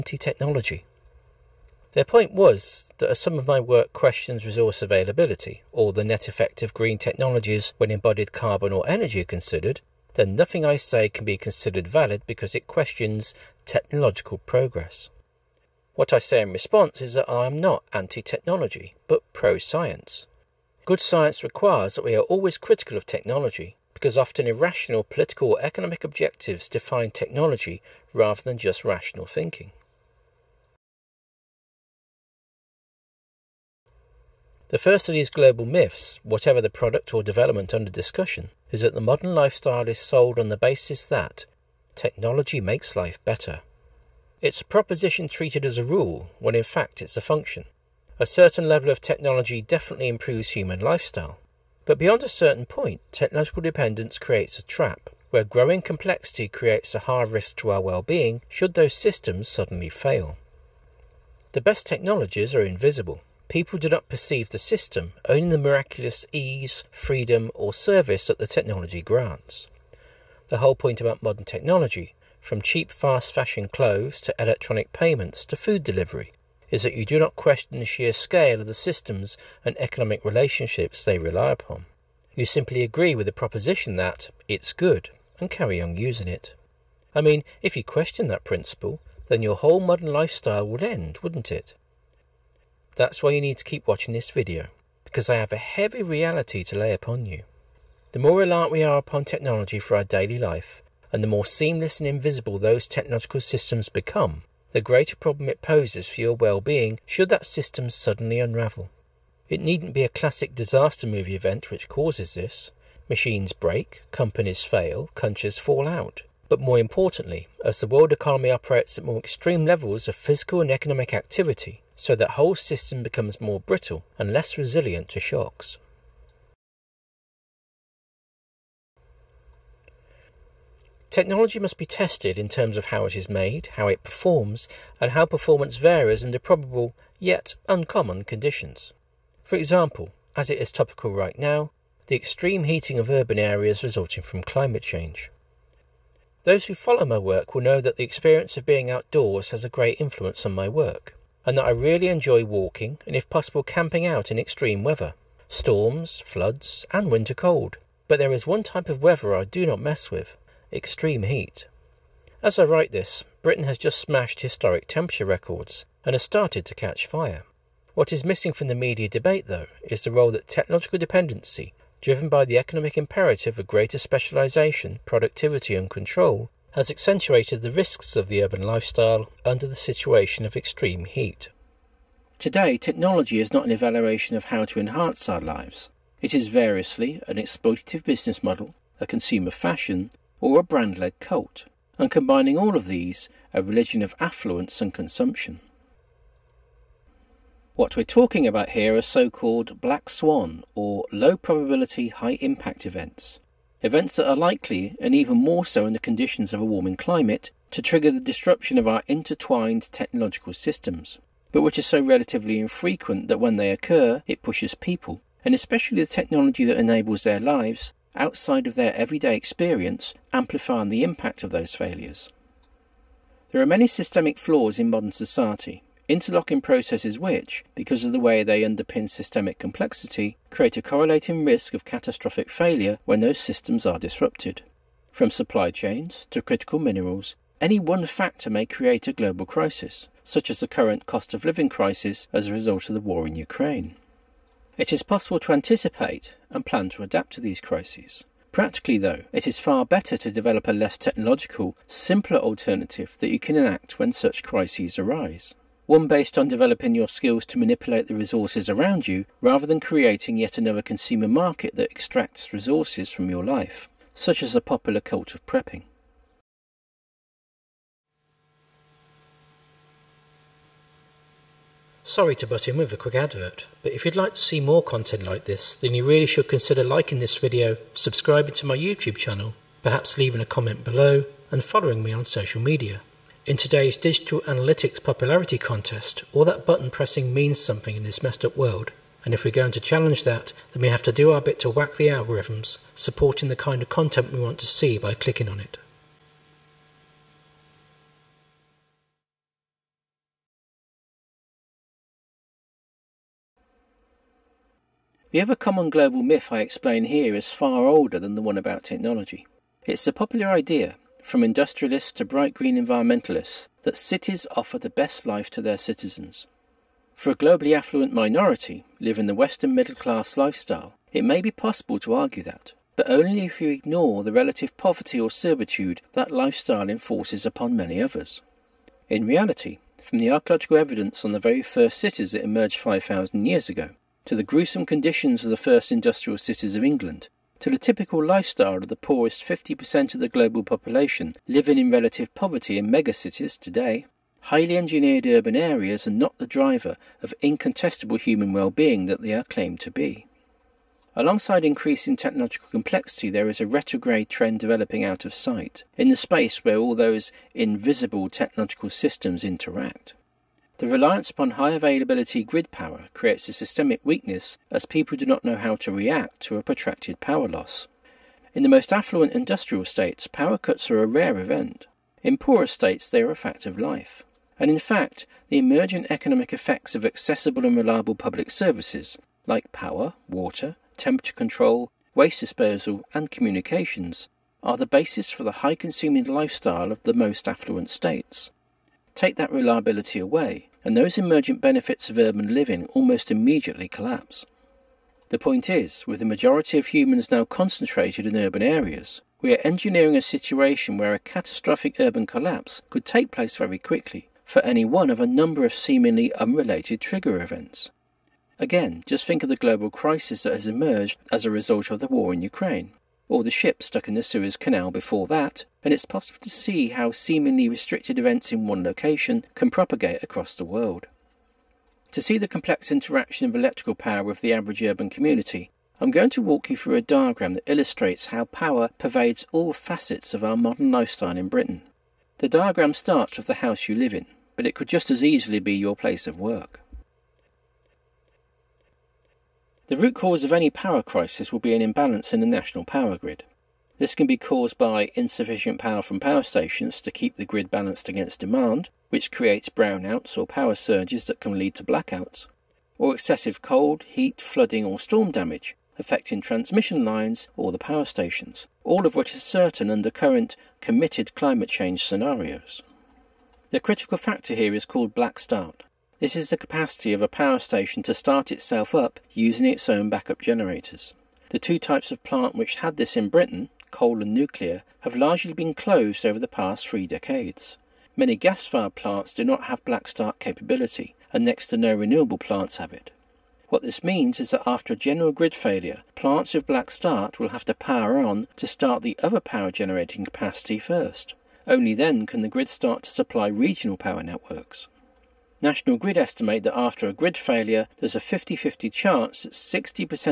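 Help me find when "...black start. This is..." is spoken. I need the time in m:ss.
7:45.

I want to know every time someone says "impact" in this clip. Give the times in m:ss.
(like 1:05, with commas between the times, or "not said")
3:22, 3:41.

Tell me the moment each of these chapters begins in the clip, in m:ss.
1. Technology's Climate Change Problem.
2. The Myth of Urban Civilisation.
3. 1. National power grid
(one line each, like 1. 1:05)
1. 2:06
2. 4:59
3. 7:16.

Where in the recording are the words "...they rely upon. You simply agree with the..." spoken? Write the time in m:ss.
1:21.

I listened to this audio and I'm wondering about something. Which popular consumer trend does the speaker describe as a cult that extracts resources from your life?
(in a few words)
prepping.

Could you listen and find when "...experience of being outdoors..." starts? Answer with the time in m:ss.
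2:28.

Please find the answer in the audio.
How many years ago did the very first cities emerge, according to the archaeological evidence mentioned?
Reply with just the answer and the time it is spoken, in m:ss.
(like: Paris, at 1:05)
5,000, at 5:32.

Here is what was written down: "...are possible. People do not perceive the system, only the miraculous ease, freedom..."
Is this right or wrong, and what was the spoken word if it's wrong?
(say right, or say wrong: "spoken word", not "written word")
wrong: "invisible", not "possible".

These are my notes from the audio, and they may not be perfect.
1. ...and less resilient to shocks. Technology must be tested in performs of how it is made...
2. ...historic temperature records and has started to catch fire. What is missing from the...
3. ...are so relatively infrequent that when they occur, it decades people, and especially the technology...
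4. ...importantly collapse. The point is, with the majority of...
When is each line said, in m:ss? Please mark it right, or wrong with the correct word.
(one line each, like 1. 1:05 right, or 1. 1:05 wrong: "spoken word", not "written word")
1. 2:04 wrong: "terms", not "performs"
2. 2:44 right
3. 3:31 wrong: "pushes", not "decades"
4. 6:33 wrong: "immediately", not "importantly".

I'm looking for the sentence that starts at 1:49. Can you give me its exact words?
It needn't be a classic disaster movie event which causes this.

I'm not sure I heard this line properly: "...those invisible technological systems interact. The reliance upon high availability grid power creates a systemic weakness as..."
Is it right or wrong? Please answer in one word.
right.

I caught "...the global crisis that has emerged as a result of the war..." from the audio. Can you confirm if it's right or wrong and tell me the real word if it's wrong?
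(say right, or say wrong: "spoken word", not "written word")
right.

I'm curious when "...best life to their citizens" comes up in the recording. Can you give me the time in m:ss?
5:14.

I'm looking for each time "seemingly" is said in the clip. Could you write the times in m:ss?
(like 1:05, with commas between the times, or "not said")
6:45, 6:57.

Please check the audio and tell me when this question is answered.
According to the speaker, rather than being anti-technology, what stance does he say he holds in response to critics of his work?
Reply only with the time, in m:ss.
0:19.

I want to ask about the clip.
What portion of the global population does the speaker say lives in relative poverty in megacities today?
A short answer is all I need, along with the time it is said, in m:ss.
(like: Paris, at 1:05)
poorest 50%, at 5:38.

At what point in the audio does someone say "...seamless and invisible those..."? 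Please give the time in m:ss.
1:41.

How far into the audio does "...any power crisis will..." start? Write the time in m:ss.
7:20.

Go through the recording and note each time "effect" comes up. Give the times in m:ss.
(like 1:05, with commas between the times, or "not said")
0:06, 6:16.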